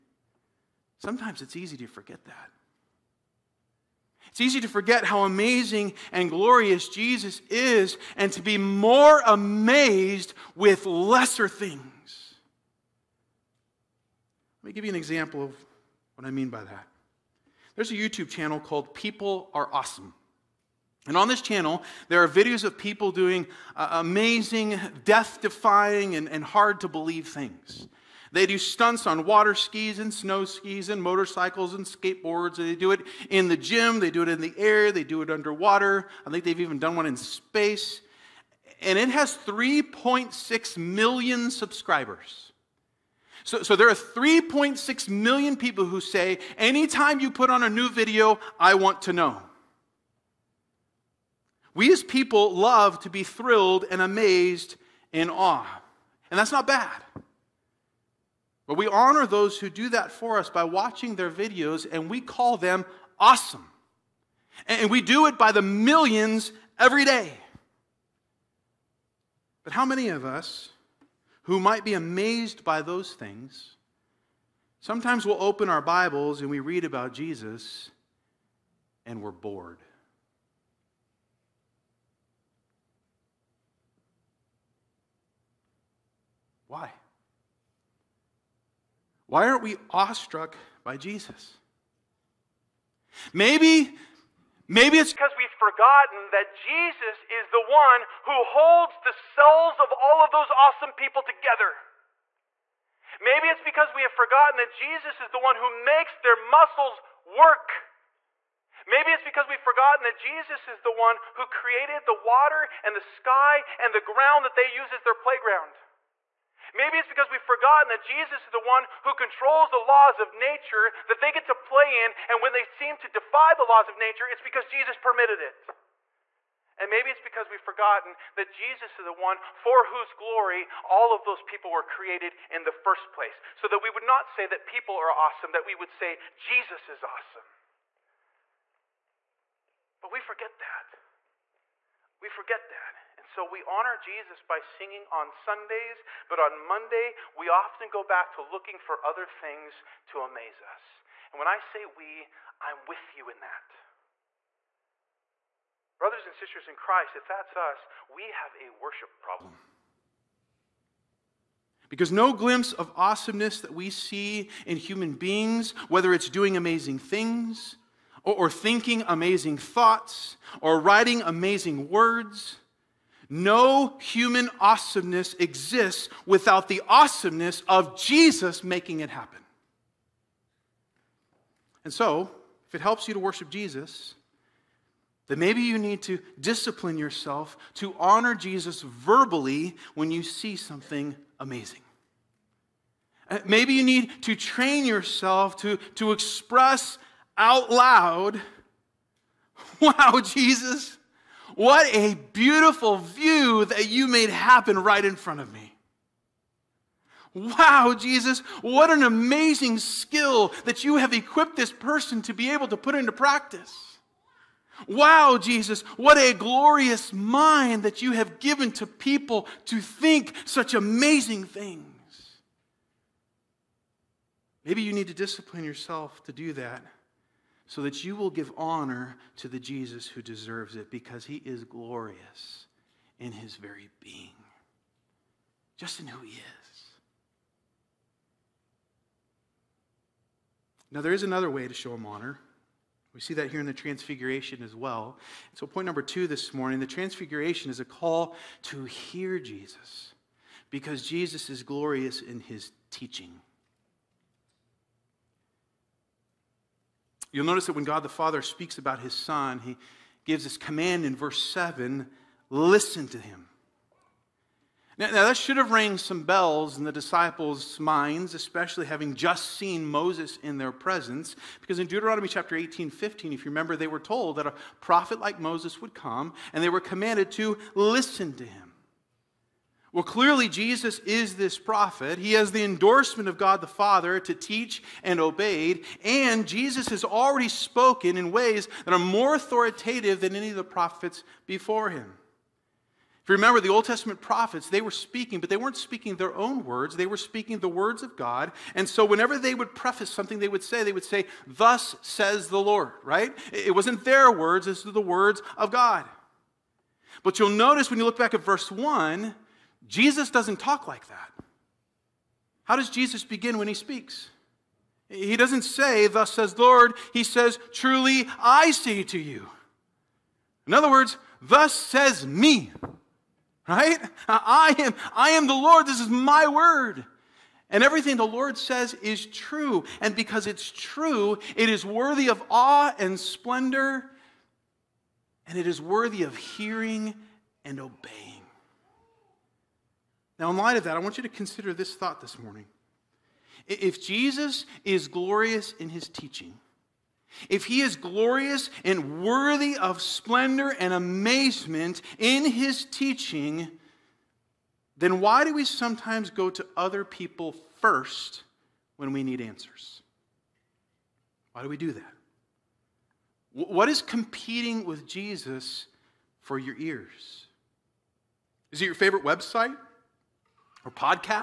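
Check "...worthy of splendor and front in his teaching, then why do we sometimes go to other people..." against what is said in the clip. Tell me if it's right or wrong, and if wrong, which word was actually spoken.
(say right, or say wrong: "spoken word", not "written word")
wrong: "amazement", not "front".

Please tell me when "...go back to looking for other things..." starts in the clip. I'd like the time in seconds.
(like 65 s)
147 s.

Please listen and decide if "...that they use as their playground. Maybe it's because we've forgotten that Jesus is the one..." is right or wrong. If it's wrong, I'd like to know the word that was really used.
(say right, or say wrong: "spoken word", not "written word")
right.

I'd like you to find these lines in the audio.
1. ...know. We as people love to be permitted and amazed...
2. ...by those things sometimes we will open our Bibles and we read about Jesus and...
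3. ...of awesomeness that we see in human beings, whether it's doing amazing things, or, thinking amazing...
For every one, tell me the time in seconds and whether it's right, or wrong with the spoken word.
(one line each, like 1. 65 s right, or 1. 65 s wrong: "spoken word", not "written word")
1. 49 s wrong: "thrilled", not "permitted"
2. 72 s right
3. 162 s right.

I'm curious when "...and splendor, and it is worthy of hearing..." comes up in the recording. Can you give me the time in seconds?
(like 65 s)
332 s.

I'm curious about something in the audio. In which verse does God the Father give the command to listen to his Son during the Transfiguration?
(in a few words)
Verse 7.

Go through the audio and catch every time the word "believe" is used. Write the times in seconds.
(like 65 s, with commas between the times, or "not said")
26 s.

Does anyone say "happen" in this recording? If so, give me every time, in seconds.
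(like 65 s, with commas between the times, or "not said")
179 s, 204 s.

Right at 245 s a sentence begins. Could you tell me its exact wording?
So, point number two this morning the Transfiguration is a call to hear Jesus because Jesus is glorious in his teaching.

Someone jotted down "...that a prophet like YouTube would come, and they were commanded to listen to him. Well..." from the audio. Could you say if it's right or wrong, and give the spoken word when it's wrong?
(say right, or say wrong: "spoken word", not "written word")
wrong: "Moses", not "YouTube".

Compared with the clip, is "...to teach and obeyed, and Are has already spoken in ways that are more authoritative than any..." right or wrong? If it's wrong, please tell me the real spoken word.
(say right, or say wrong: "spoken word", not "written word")
wrong: "Jesus", not "Are".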